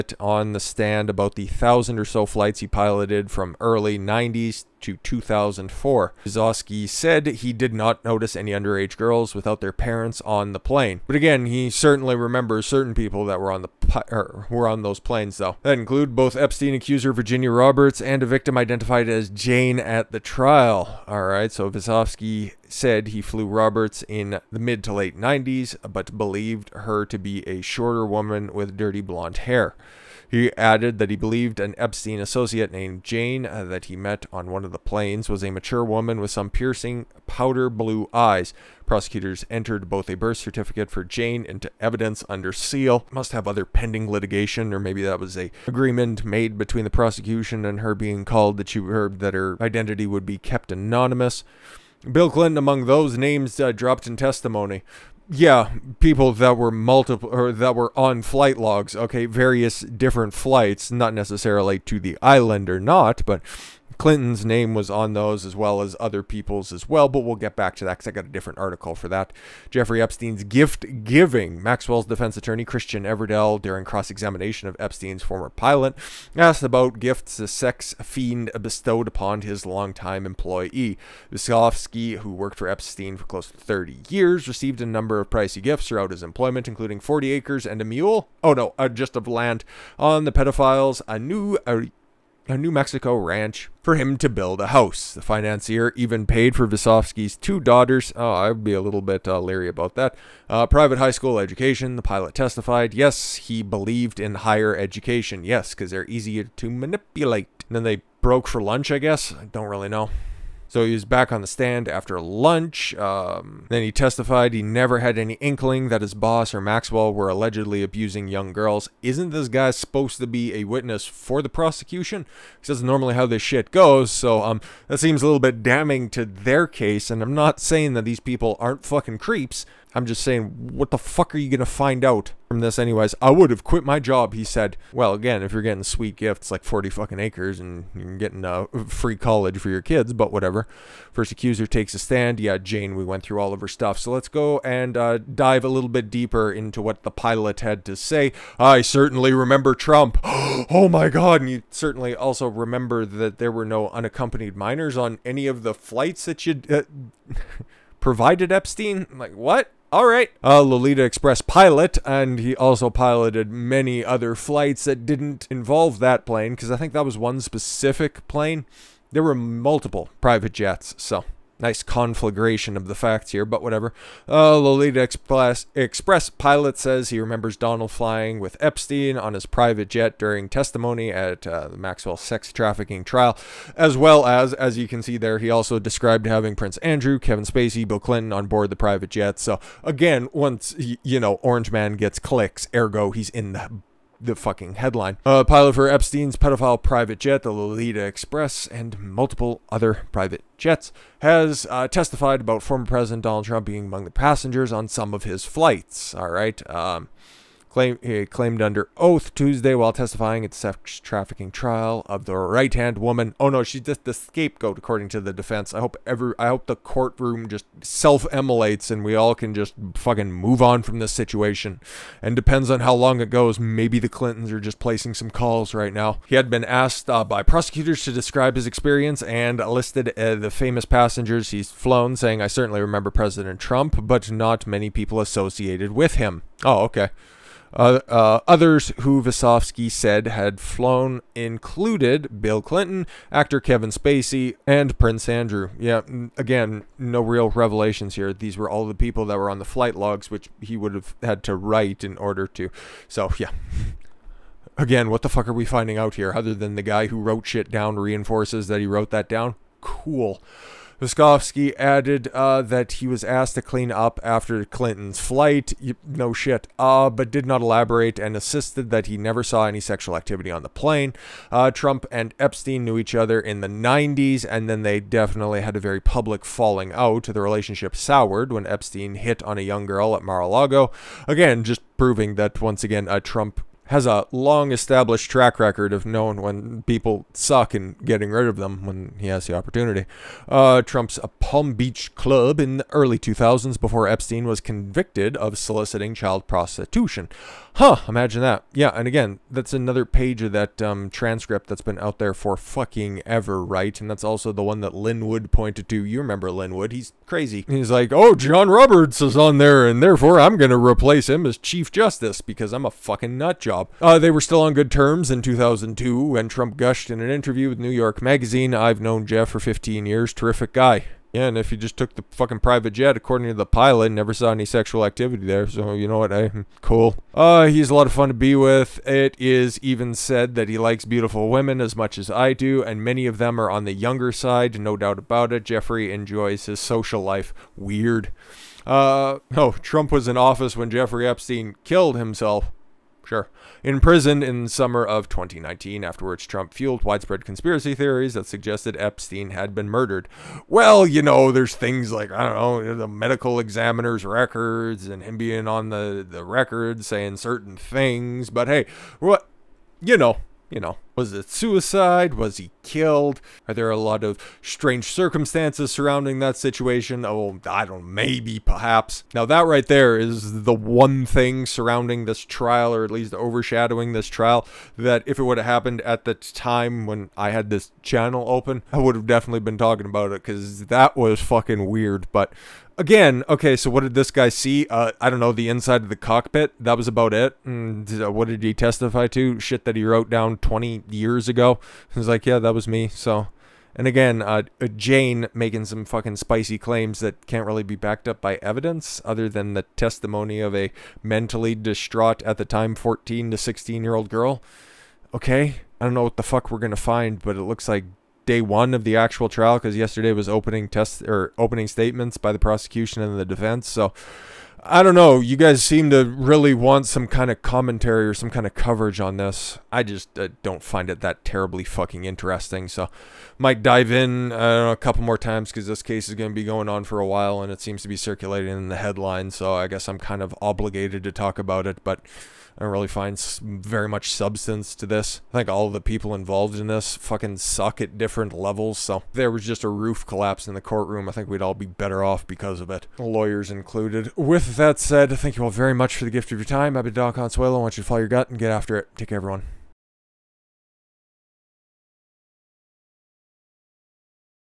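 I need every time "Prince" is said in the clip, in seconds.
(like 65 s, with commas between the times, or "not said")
186 s, 244 s.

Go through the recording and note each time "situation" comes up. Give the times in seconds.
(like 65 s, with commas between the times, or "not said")
221 s, 366 s.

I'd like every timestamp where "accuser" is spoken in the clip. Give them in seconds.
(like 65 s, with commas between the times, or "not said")
16 s, 141 s.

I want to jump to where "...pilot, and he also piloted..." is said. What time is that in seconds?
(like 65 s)
161 s.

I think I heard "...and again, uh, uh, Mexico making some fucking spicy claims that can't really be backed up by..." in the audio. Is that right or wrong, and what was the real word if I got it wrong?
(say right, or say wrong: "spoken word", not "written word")
wrong: "Jane", not "Mexico".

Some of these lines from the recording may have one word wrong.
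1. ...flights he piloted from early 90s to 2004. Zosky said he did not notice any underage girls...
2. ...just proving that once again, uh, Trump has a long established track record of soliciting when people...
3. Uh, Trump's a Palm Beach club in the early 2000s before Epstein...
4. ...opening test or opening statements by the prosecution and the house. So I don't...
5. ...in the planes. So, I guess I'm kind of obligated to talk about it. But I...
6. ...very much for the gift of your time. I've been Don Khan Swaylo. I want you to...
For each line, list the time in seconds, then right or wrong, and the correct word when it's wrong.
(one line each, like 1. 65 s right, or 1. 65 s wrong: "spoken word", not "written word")
1. 2 s right
2. 281 s wrong: "knowing", not "soliciting"
3. 290 s right
4. 410 s wrong: "defense", not "house"
5. 428 s wrong: "headlines", not "planes"
6. 445 s right.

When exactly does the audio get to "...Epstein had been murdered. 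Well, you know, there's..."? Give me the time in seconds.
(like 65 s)
348 s.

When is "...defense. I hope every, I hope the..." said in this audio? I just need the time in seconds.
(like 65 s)
215 s.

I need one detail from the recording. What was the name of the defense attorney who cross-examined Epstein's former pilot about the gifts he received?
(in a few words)
Christian Everdell.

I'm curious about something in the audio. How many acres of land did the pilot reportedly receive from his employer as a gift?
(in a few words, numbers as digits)
40.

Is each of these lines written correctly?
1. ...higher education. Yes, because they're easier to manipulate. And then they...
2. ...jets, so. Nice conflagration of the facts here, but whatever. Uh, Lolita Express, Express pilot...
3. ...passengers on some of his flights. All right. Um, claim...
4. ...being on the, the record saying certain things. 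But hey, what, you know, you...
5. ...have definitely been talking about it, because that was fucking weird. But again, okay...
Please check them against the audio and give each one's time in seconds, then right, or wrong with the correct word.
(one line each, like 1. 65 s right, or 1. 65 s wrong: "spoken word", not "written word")
1. 104 s right
2. 170 s right
3. 204 s right
4. 355 s right
5. 379 s right.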